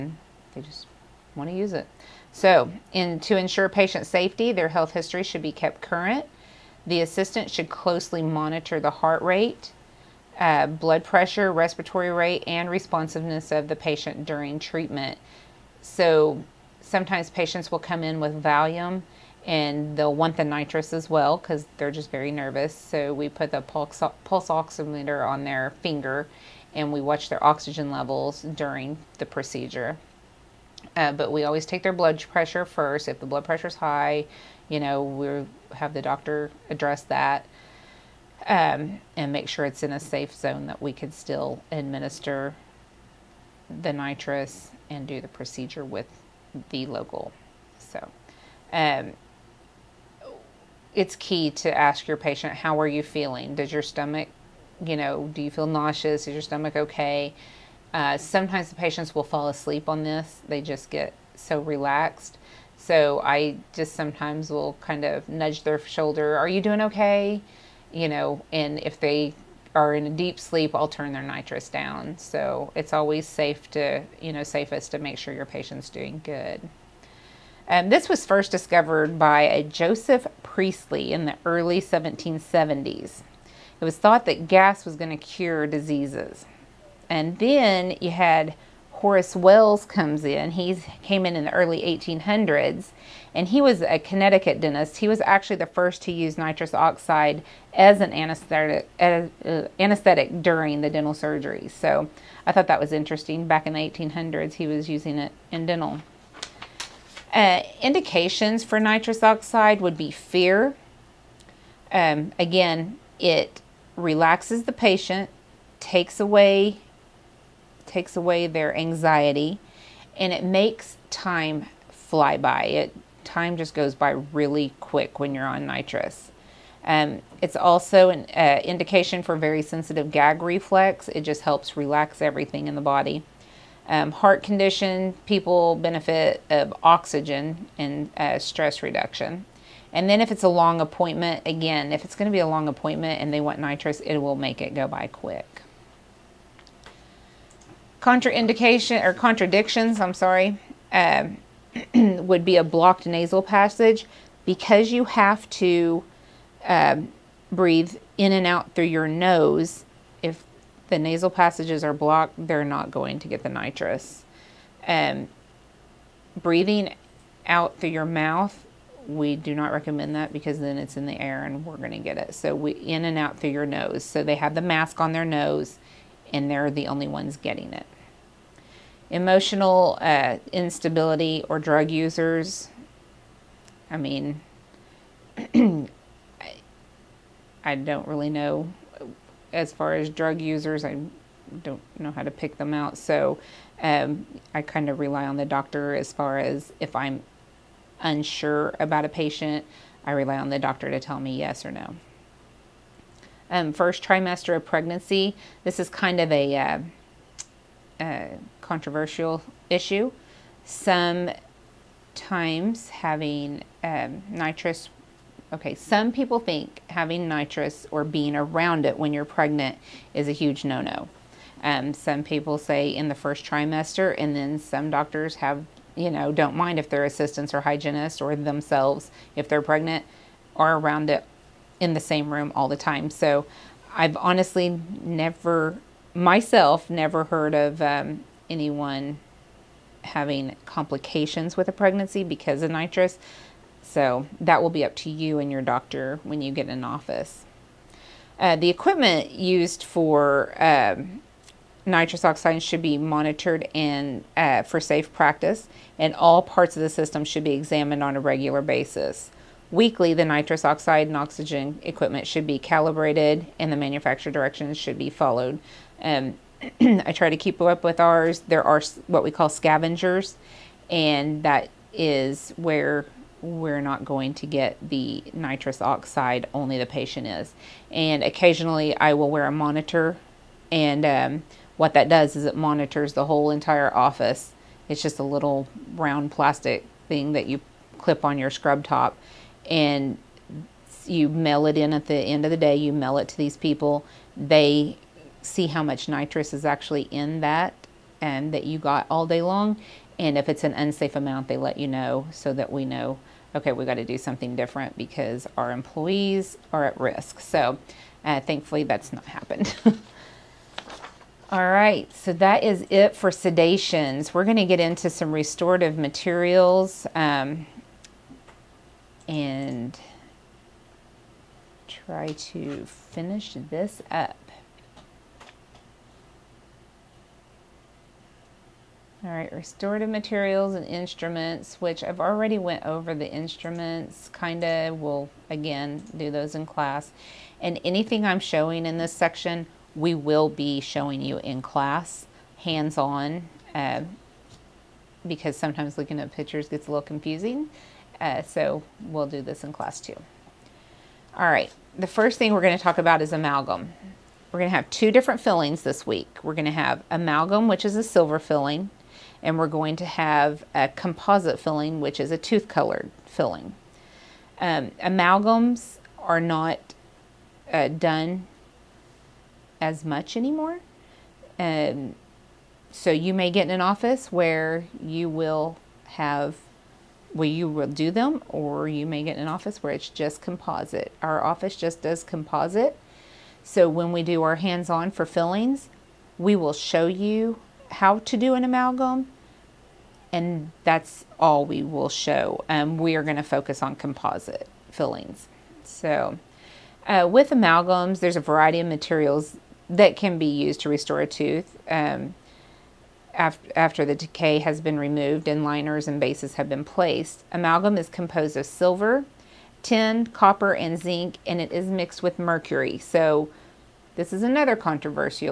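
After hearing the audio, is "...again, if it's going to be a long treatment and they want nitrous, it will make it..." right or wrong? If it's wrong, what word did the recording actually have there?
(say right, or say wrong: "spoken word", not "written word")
wrong: "appointment", not "treatment".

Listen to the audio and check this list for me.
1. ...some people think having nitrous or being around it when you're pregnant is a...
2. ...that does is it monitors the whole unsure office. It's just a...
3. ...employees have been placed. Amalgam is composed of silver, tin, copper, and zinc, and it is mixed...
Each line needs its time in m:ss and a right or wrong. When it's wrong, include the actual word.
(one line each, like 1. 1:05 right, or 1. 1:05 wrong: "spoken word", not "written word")
1. 3:35 right
2. 4:41 wrong: "entire", not "unsure"
3. 6:46 wrong: "bases", not "employees".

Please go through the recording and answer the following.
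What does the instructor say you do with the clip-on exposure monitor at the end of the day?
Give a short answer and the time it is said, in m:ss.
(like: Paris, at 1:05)
mail it in, at 4:51.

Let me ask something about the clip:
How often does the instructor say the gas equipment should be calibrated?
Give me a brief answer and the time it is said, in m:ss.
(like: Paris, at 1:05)
Weekly, at 4:19.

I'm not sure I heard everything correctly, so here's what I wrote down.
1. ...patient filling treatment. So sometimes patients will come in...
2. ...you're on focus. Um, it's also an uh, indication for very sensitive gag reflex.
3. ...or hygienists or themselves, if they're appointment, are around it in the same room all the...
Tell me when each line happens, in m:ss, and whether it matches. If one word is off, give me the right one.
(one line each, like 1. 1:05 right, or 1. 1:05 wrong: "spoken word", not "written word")
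1. 0:13 wrong: "during", not "filling"
2. 2:05 wrong: "nitrous", not "focus"
3. 3:47 wrong: "pregnant", not "appointment".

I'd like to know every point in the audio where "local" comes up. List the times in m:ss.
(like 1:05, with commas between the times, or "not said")
0:46.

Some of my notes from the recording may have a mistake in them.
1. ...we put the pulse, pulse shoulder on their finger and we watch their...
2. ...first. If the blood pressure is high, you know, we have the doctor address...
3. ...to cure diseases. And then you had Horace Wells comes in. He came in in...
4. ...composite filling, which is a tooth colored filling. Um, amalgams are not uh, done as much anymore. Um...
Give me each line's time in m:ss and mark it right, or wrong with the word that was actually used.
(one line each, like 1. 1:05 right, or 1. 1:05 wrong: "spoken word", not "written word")
1. 0:23 wrong: "oximeter", not "shoulder"
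2. 0:32 right
3. 1:25 right
4. 6:00 right.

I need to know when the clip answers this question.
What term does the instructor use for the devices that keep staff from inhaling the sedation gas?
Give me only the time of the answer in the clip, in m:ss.
4:29.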